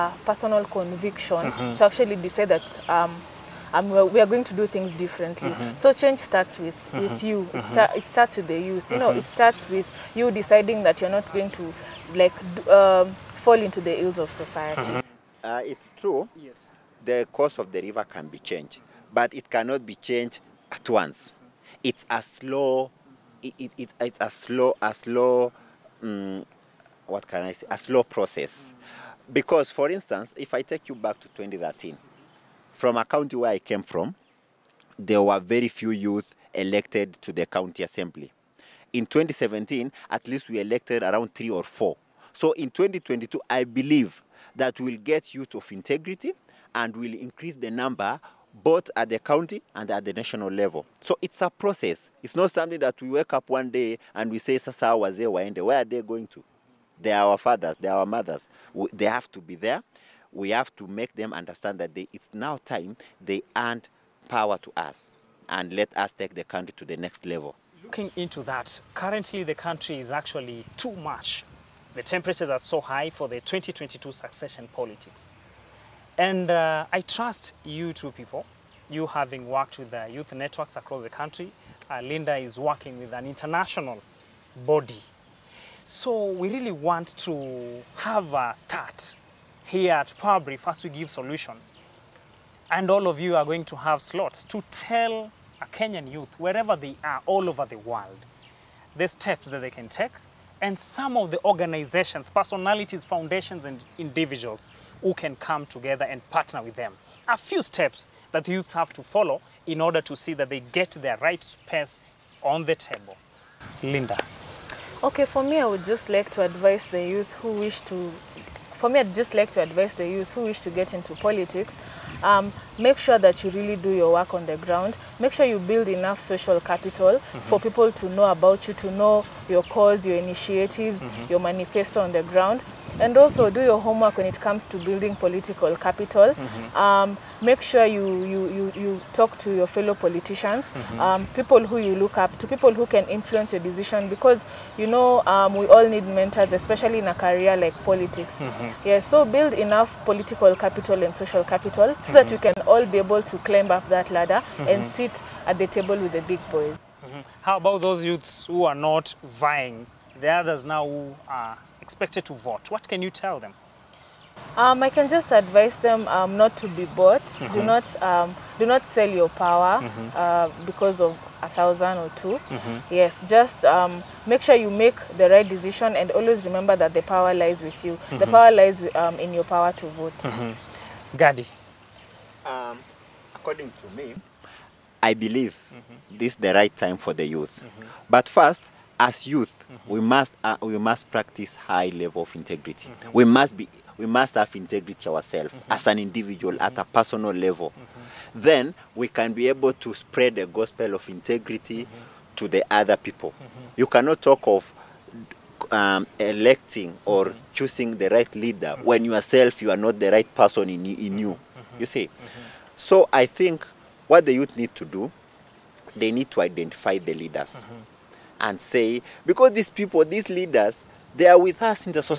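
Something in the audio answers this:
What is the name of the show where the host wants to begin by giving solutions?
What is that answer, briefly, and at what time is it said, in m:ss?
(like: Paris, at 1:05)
Power Brief, at 1:30.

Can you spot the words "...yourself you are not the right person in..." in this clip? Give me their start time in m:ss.
3:29.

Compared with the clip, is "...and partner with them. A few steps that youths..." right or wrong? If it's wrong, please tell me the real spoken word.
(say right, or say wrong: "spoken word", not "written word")
right.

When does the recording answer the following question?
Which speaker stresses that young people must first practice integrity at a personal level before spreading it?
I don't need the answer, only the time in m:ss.
3:01.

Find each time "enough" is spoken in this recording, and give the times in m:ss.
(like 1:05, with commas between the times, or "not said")
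2:05, 2:29.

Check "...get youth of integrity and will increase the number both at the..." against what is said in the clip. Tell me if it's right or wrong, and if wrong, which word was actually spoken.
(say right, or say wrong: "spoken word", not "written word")
right.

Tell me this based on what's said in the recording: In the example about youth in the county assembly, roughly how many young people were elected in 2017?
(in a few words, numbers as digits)
3 or 4.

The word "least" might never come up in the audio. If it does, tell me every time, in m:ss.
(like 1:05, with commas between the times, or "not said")
0:40.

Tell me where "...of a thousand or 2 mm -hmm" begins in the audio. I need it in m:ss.
2:51.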